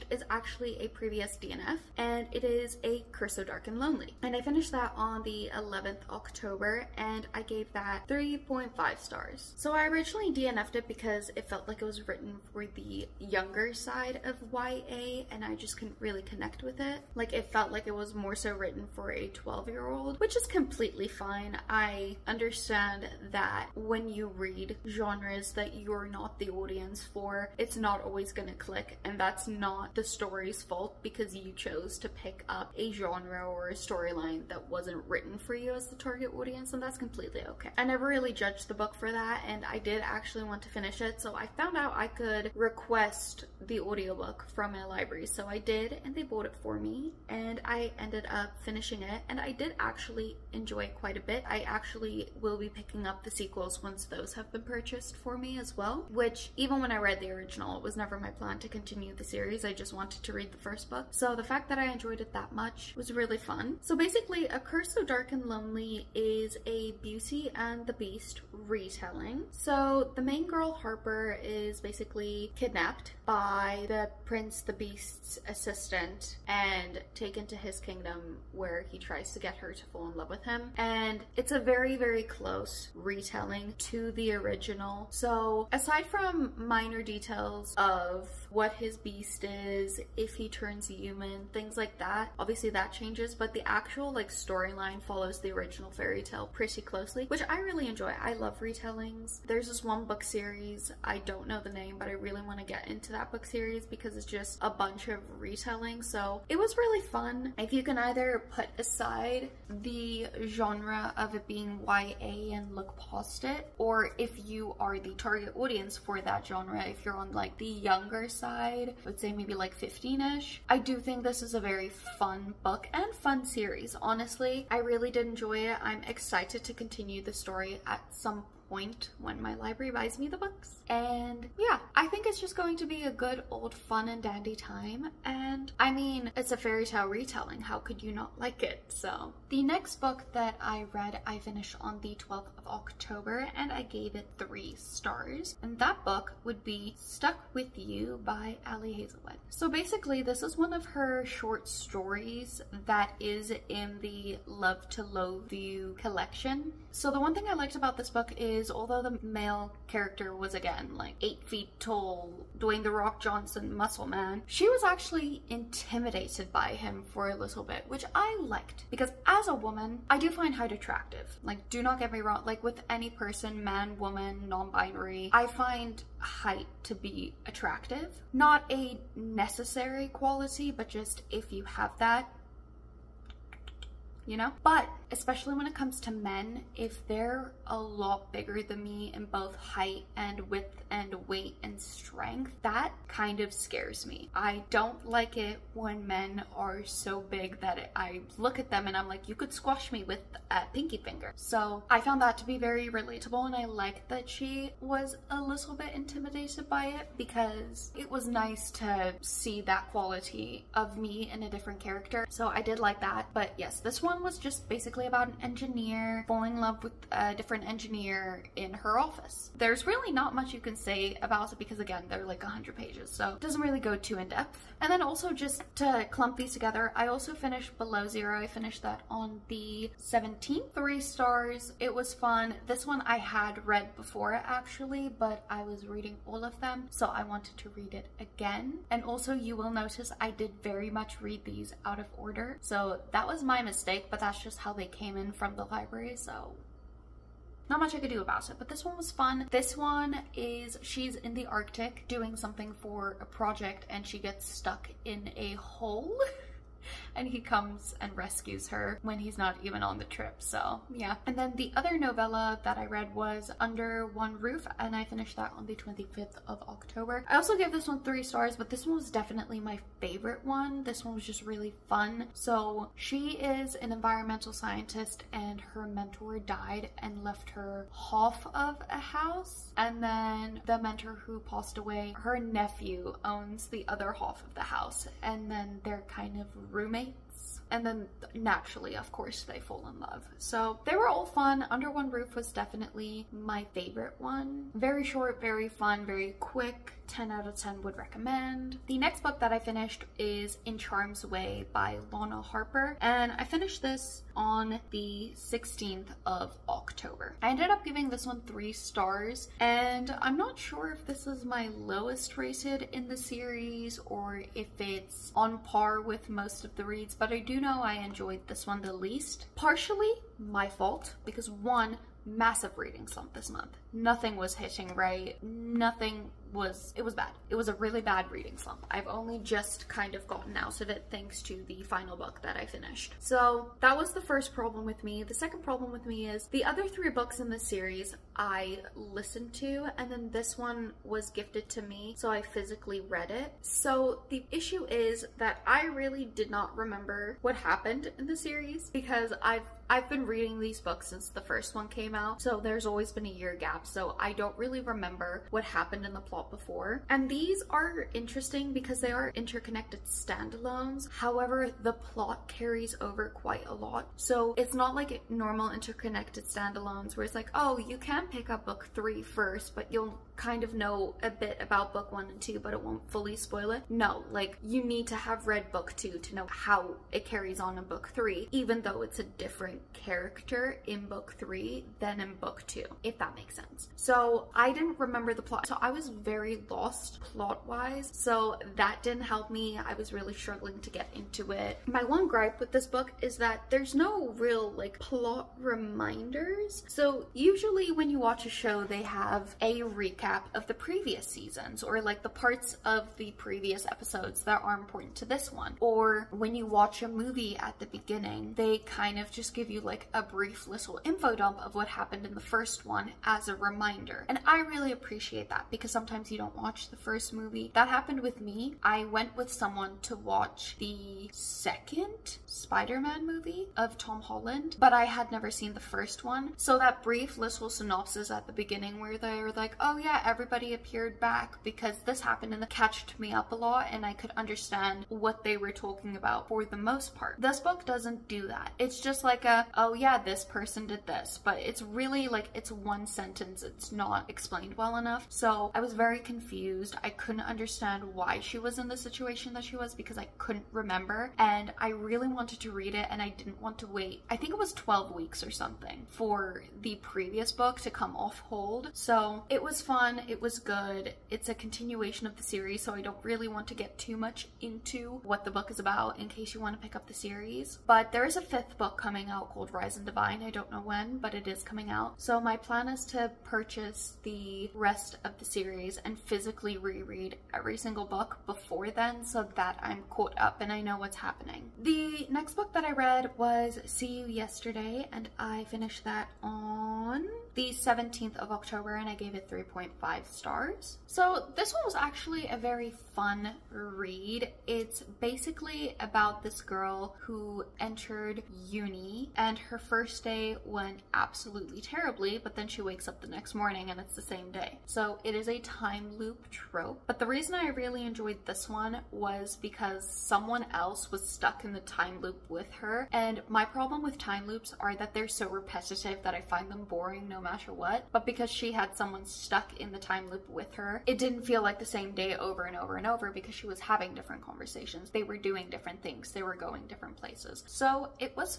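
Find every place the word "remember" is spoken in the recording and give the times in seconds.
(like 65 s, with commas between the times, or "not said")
346 s, 354 s, 384 s, 450 s.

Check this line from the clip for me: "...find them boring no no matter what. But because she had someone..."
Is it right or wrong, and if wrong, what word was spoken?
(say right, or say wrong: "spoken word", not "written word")
right.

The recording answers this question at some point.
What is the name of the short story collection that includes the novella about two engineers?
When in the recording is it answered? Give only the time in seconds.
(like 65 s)
154 s.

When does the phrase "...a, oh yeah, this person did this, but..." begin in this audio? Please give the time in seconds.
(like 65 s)
439 s.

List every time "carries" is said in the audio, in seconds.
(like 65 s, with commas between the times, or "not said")
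362 s, 377 s.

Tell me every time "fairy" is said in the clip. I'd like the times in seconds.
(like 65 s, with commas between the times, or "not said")
95 s, 136 s.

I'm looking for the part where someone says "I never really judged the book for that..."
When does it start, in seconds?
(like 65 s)
37 s.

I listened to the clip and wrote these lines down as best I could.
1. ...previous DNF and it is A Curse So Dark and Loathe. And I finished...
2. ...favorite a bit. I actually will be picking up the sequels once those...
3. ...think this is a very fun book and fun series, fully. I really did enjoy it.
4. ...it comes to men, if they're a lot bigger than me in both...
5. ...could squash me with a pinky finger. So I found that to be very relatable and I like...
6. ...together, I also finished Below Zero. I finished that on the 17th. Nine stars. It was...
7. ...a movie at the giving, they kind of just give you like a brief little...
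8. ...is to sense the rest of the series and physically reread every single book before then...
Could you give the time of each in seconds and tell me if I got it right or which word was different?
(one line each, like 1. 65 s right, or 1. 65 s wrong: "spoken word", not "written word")
1. 0 s wrong: "Lonely", not "Loathe"
2. 50 s wrong: "quite", not "favorite"
3. 120 s wrong: "honestly", not "fully"
4. 185 s right
5. 199 s right
6. 226 s wrong: "Three", not "Nine"
7. 407 s wrong: "beginning", not "giving"
8. 472 s wrong: "purchase", not "sense".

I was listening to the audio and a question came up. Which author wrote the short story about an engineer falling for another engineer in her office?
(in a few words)
Ali Hazelwood.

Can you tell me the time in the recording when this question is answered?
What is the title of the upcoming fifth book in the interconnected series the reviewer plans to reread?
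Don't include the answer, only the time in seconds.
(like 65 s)
469 s.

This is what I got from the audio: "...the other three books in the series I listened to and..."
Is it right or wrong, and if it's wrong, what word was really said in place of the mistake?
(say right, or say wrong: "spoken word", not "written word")
right.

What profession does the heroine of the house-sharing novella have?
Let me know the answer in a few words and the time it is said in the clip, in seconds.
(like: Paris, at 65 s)
environmental scientist, at 273 s.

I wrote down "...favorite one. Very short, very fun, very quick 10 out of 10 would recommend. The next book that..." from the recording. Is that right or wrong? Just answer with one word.
right.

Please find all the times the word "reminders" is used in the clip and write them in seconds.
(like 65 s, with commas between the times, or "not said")
395 s, 413 s.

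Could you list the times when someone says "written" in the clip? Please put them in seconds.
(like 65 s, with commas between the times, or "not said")
12 s, 18 s, 35 s.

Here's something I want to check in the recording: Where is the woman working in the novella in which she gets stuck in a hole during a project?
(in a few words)
the Arctic.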